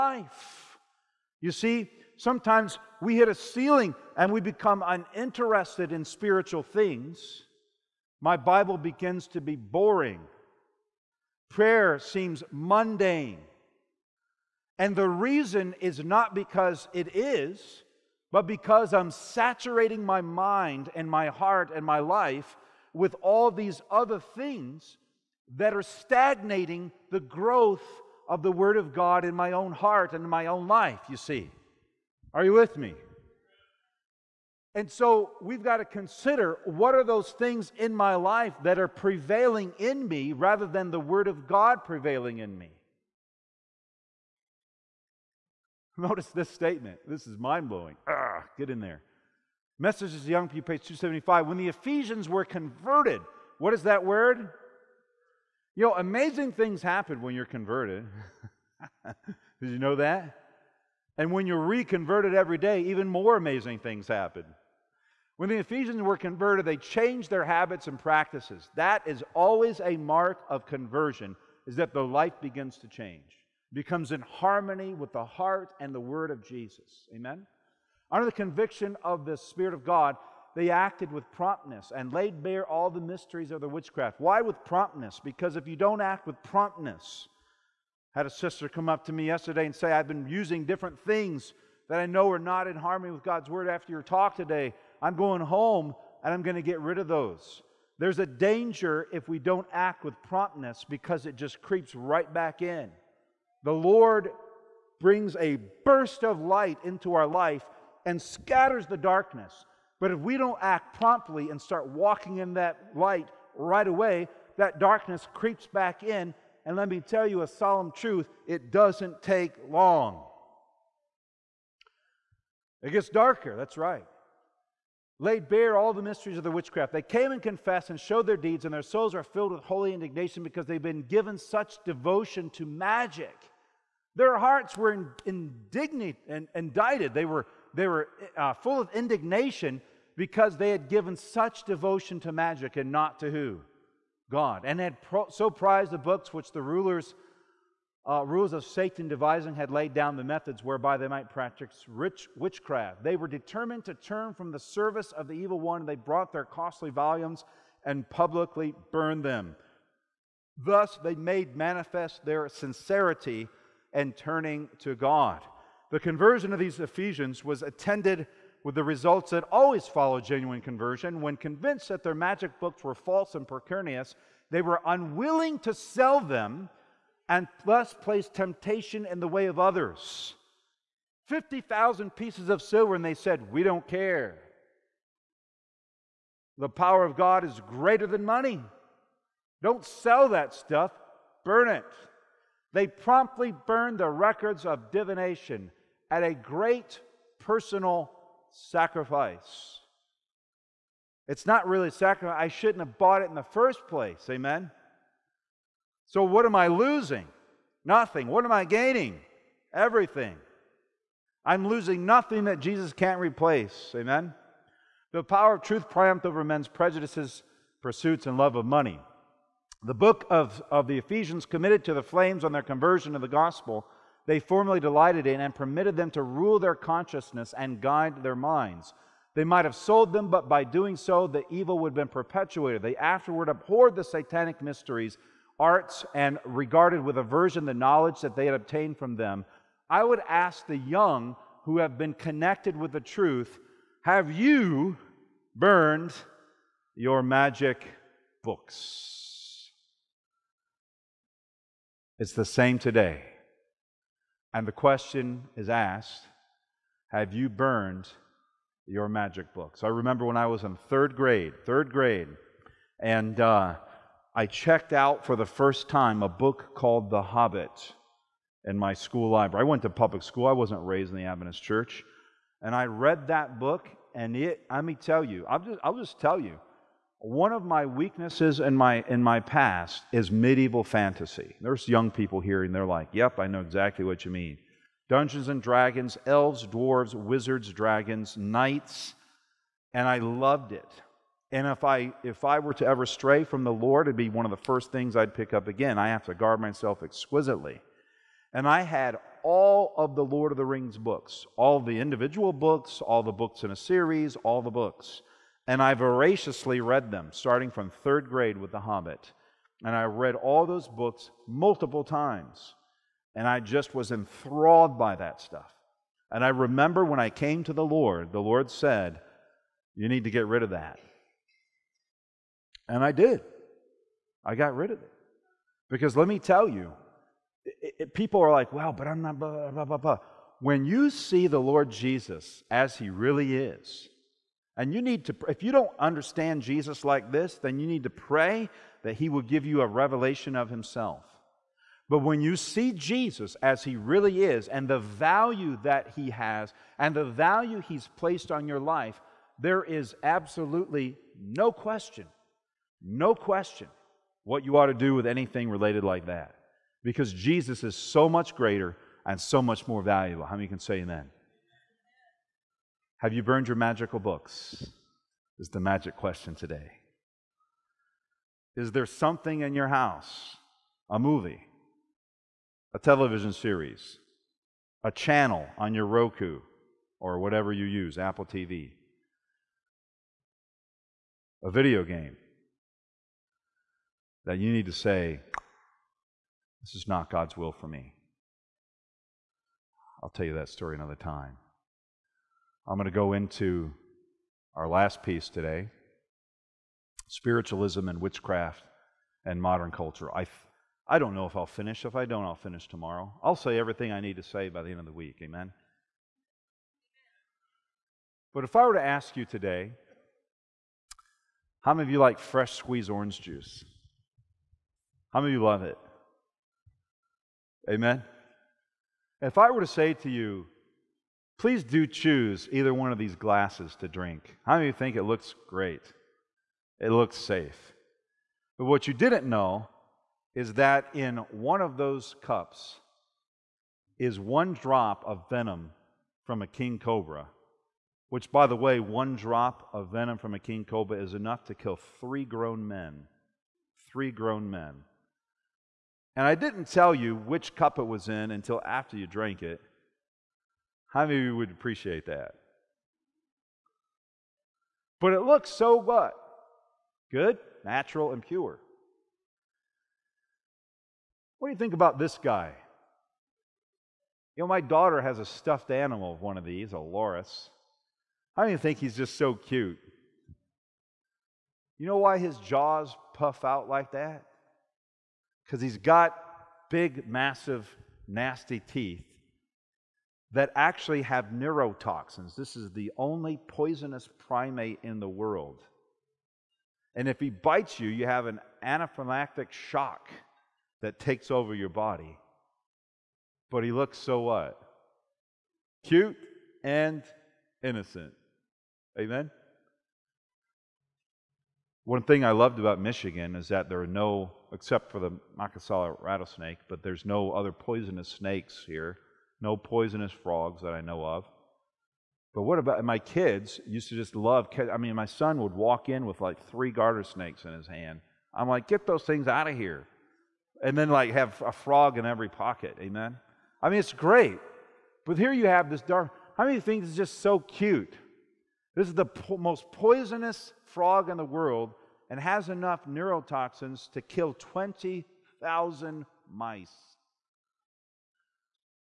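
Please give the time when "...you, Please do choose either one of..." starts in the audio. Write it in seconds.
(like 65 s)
420 s.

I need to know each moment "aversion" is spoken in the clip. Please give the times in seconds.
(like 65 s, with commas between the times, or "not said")
237 s.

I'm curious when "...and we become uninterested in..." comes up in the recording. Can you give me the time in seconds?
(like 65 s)
4 s.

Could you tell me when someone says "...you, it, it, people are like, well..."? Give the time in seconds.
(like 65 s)
326 s.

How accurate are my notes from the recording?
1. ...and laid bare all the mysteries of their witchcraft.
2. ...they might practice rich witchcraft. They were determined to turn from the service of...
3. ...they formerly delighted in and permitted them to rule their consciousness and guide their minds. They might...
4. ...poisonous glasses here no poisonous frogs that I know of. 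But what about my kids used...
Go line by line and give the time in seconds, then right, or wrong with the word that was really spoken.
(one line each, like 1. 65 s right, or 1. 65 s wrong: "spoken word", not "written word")
1. 81 s right
2. 150 s right
3. 224 s right
4. 507 s wrong: "snakes", not "glasses".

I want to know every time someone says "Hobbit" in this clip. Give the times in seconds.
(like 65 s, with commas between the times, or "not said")
267 s, 308 s.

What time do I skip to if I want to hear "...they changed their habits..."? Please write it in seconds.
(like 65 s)
66 s.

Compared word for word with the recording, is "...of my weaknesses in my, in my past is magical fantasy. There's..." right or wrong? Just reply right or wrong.
wrong.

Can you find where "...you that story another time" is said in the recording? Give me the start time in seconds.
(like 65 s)
390 s.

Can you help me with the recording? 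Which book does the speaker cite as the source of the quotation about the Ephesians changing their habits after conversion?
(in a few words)
Messages to Young People.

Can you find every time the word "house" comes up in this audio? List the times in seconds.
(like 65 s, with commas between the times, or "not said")
369 s.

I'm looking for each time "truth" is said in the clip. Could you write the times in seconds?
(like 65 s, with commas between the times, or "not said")
117 s, 215 s, 242 s.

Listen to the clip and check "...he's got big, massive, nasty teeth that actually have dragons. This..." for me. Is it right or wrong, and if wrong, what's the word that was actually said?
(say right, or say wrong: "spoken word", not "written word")
wrong: "neurotoxins", not "dragons".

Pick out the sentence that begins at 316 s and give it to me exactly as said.
And I remember when I came to the Lord, the Lord said, You need to get rid of that.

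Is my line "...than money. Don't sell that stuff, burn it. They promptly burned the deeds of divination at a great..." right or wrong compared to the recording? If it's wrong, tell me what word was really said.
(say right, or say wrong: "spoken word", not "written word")
wrong: "records", not "deeds".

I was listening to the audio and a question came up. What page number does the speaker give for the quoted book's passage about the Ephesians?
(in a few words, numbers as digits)
275.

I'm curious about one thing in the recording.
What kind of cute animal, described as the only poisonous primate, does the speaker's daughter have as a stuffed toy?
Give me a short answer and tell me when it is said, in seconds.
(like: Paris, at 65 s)
A loris, at 466 s.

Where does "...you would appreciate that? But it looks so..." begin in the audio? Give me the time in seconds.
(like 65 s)
451 s.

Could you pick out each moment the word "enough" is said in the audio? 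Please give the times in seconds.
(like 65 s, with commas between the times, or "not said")
441 s, 532 s.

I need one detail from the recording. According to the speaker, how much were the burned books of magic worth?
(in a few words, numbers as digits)
50,000 pieces of silver.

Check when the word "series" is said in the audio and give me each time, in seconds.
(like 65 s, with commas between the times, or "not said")
303 s, 373 s.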